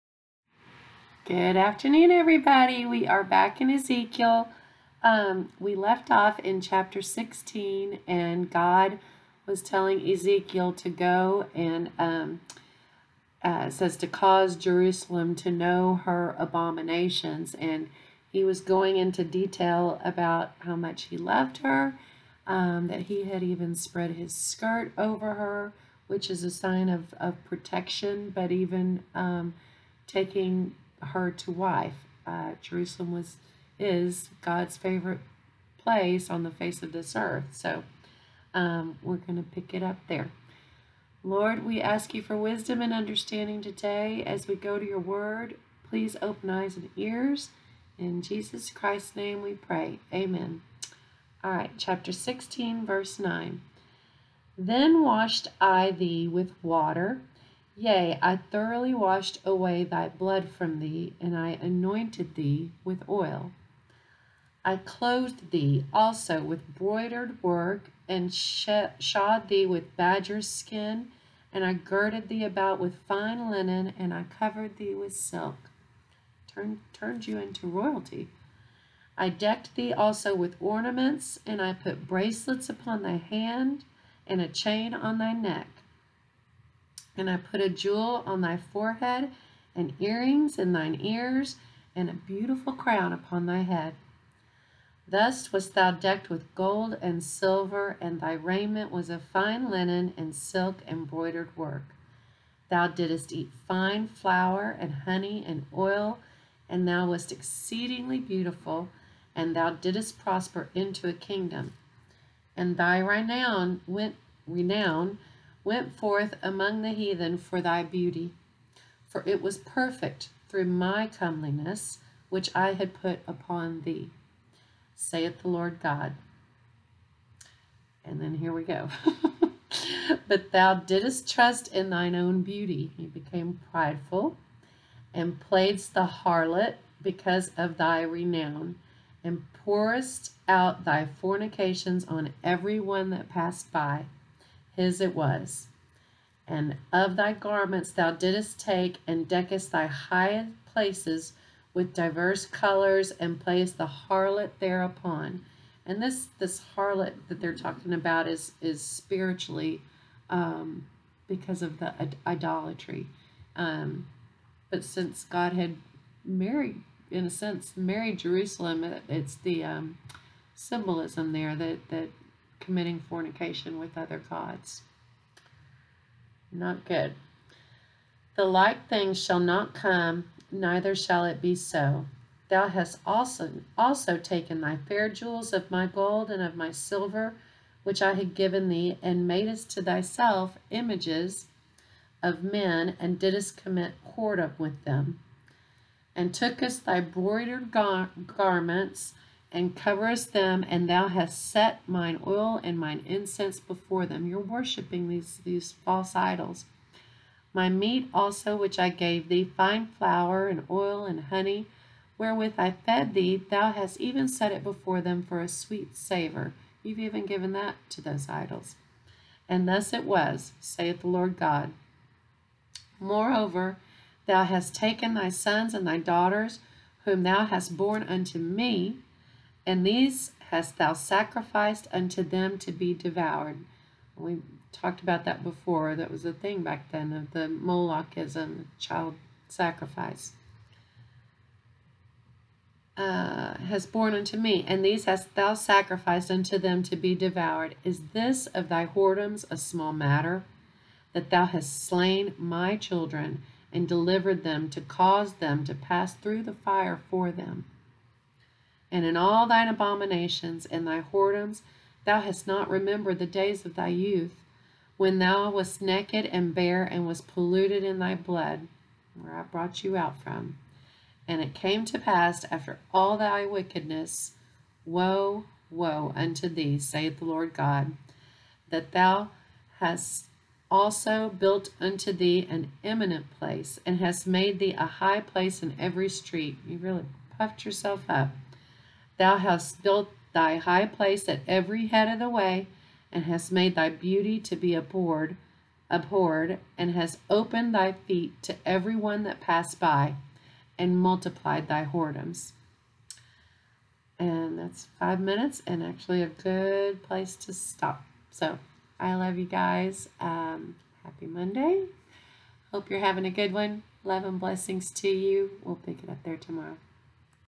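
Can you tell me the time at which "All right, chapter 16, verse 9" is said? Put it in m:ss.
0:51.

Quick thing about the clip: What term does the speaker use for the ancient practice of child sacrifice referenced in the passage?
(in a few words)
Molochism.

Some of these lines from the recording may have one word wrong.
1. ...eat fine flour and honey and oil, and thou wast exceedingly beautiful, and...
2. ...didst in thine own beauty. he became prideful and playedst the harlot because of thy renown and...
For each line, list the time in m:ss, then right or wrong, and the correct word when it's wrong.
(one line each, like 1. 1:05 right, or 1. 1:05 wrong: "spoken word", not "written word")
1. 1:43 right
2. 2:11 wrong: "trust", not "didst".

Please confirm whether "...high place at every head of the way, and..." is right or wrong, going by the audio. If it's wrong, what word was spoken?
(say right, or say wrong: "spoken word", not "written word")
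right.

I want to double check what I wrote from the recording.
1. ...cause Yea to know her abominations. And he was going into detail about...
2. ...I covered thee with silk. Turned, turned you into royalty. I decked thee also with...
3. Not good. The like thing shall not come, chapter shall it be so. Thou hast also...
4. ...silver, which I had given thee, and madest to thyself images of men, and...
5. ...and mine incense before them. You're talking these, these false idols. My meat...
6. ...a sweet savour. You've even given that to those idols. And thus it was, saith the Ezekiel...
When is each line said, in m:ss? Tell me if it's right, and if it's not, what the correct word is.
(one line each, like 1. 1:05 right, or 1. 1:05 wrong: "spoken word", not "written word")
1. 0:14 wrong: "Jerusalem", not "Yea"
2. 1:14 right
3. 2:56 wrong: "neither", not "chapter"
4. 3:06 right
5. 3:22 wrong: "worshiping", not "talking"
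6. 3:35 wrong: "Lord", not "Ezekiel".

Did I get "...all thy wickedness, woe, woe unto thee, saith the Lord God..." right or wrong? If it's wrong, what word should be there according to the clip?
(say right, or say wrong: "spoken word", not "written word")
right.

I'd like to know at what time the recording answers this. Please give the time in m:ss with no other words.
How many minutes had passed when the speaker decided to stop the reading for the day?
5:04.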